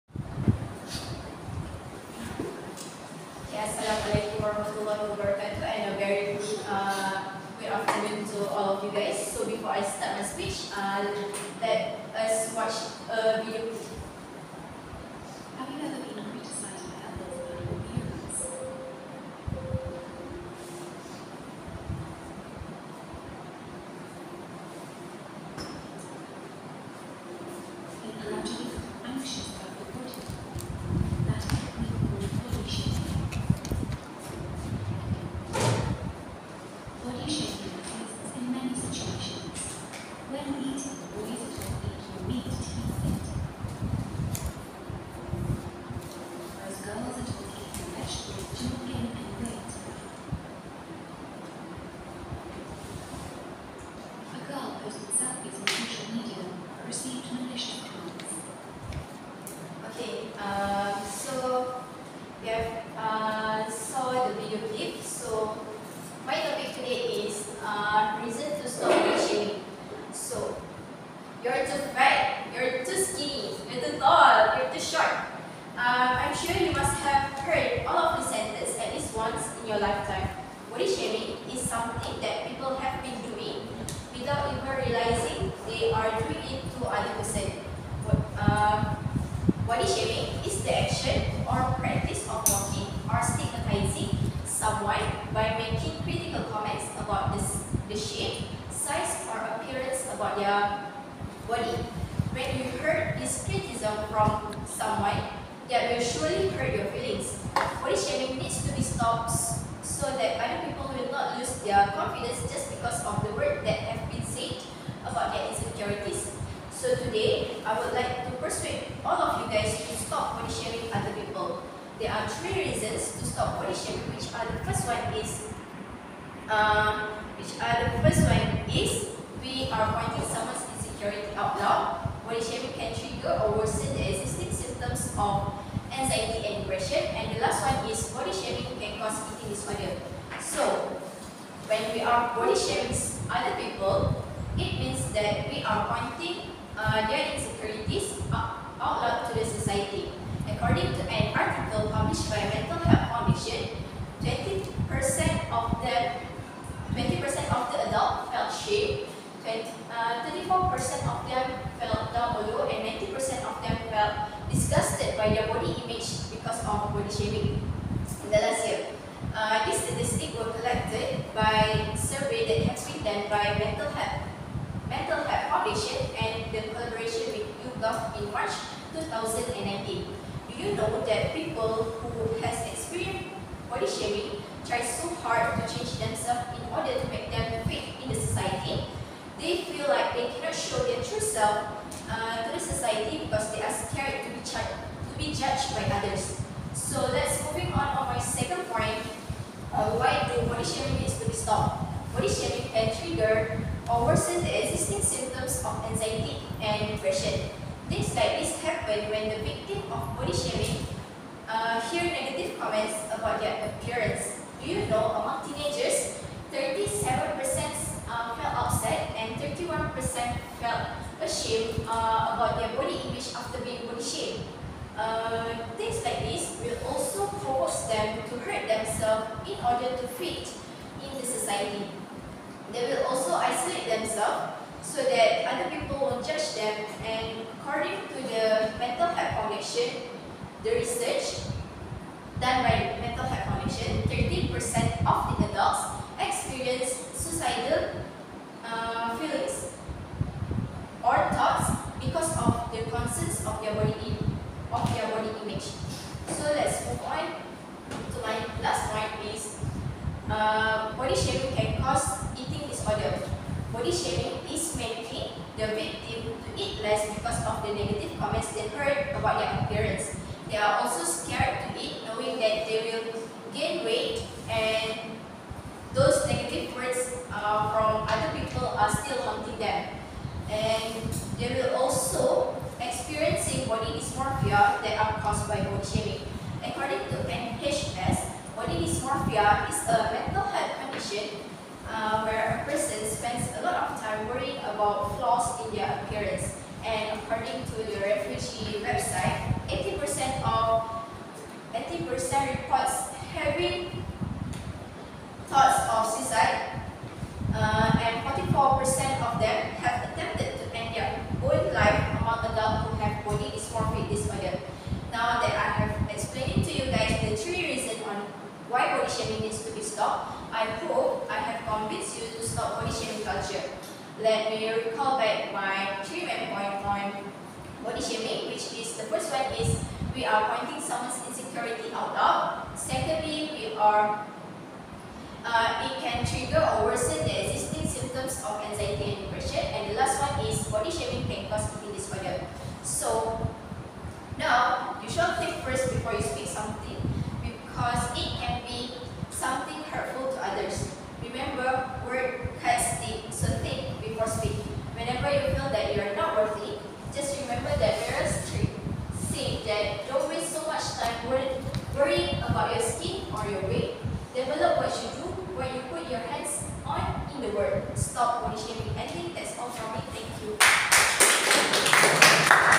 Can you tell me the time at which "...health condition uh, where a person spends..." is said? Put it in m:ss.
4:50.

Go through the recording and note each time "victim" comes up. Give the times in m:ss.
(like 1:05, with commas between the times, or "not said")
3:29, 4:25.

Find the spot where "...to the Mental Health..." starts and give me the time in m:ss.
3:58.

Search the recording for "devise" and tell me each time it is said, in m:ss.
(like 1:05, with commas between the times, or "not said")
not said.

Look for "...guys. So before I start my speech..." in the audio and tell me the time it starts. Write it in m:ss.
0:08.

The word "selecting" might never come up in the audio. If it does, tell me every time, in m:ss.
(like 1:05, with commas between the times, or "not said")
not said.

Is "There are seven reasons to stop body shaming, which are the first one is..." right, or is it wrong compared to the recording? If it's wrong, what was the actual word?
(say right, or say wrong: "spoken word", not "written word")
wrong: "three", not "seven".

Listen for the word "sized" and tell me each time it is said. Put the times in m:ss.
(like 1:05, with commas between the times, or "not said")
not said.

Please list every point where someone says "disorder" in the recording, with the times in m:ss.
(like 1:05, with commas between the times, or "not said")
2:19, 5:41.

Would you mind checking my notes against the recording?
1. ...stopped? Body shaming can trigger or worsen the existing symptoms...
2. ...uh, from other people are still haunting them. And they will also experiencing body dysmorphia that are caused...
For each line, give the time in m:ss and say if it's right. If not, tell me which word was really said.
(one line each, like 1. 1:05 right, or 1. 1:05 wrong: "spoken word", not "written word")
1. 3:21 right
2. 4:37 right.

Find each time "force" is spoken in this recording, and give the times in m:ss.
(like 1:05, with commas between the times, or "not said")
3:47.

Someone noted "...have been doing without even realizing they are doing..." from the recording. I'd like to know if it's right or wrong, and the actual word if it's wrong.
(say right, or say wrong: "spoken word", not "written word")
right.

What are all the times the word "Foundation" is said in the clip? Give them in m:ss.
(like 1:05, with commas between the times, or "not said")
2:55, 3:59, 4:03.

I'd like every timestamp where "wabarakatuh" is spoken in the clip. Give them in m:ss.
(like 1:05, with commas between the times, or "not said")
0:05.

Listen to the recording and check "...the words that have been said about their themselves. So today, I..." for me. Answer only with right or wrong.
wrong.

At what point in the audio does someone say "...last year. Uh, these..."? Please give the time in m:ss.
2:48.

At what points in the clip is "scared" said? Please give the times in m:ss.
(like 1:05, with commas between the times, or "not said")
3:13, 4:31.